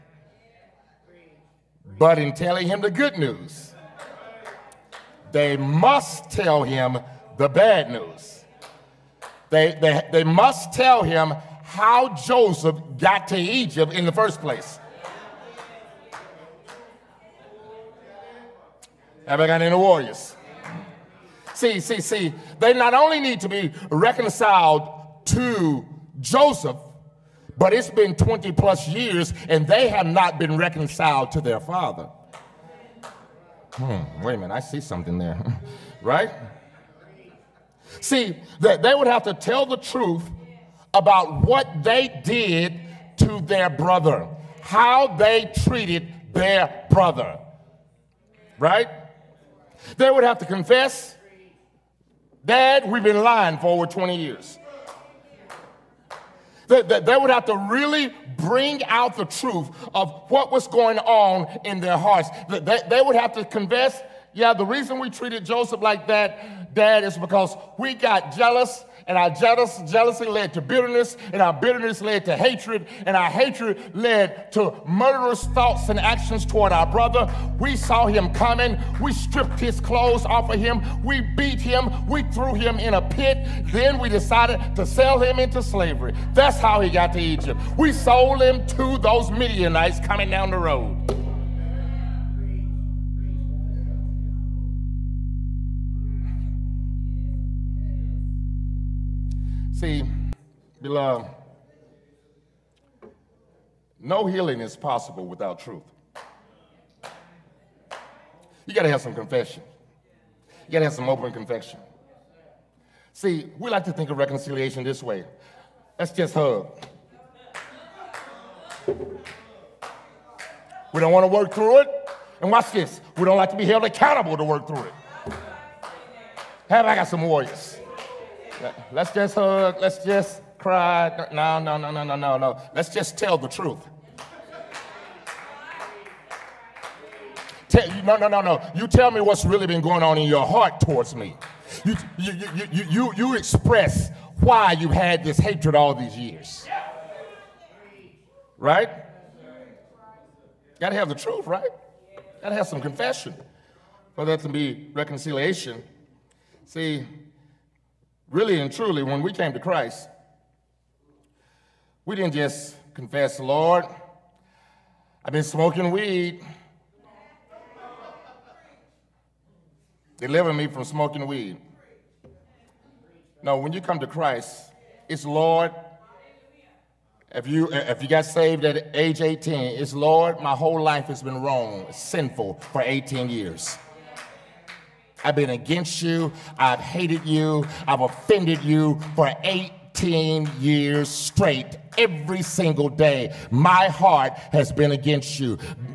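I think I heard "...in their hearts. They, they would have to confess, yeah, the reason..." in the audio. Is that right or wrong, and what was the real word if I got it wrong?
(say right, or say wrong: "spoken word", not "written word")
right.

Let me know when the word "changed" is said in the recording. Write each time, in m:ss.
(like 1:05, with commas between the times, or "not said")
not said.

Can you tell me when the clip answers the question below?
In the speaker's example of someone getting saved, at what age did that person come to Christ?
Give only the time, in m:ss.
2:58.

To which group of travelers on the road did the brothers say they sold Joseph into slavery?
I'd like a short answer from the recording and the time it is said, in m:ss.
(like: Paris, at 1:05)
Midianites, at 1:29.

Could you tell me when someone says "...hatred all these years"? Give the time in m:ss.
2:25.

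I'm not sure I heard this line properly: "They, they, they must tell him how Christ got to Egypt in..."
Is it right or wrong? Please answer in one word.
wrong.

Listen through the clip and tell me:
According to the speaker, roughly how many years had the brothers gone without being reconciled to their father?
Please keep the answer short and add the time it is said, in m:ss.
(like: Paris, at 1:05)
20 plus years, at 0:28.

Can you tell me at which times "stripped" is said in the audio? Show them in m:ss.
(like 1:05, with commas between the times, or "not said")
1:19.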